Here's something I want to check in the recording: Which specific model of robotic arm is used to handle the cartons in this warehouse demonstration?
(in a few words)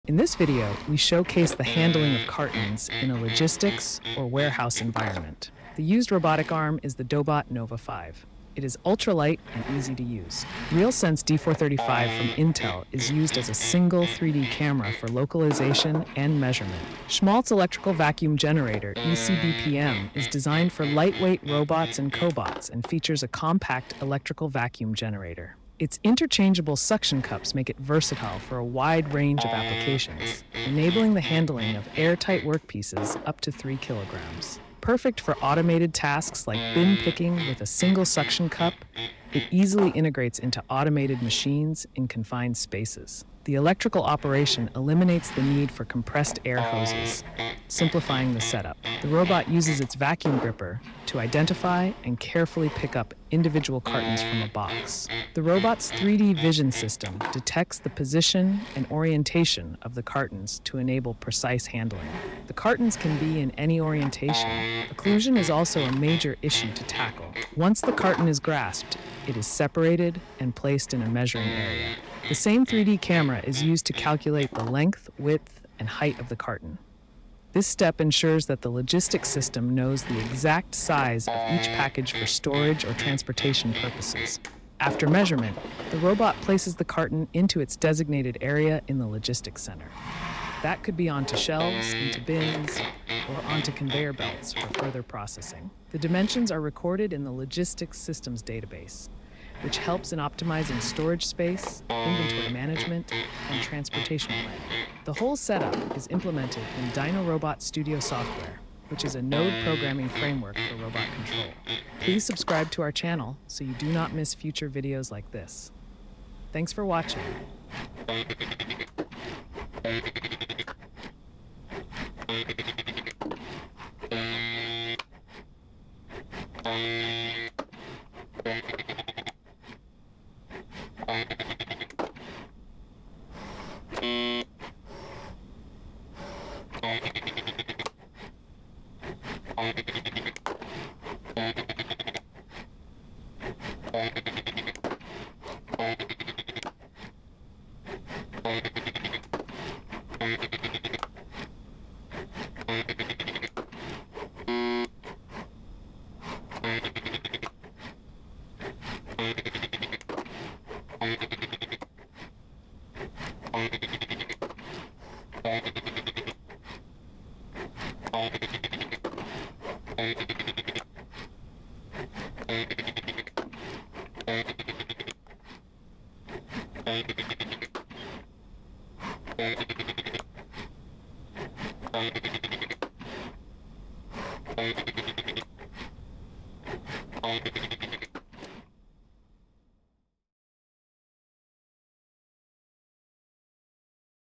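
Dobot Nova 5.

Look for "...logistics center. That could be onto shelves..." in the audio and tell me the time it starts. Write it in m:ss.
1:29.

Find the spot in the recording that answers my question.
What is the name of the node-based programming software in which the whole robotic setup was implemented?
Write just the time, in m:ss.
1:46.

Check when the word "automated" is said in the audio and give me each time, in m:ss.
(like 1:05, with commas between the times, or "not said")
0:35, 0:40.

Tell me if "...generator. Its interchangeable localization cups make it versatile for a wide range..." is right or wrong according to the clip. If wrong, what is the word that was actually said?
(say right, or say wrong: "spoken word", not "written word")
wrong: "suction", not "localization".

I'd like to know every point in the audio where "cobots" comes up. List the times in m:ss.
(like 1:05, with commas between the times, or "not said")
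0:22.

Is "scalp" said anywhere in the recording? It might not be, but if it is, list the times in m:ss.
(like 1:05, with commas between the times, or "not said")
not said.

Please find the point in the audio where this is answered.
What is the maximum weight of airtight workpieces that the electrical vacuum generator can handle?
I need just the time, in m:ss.
0:33.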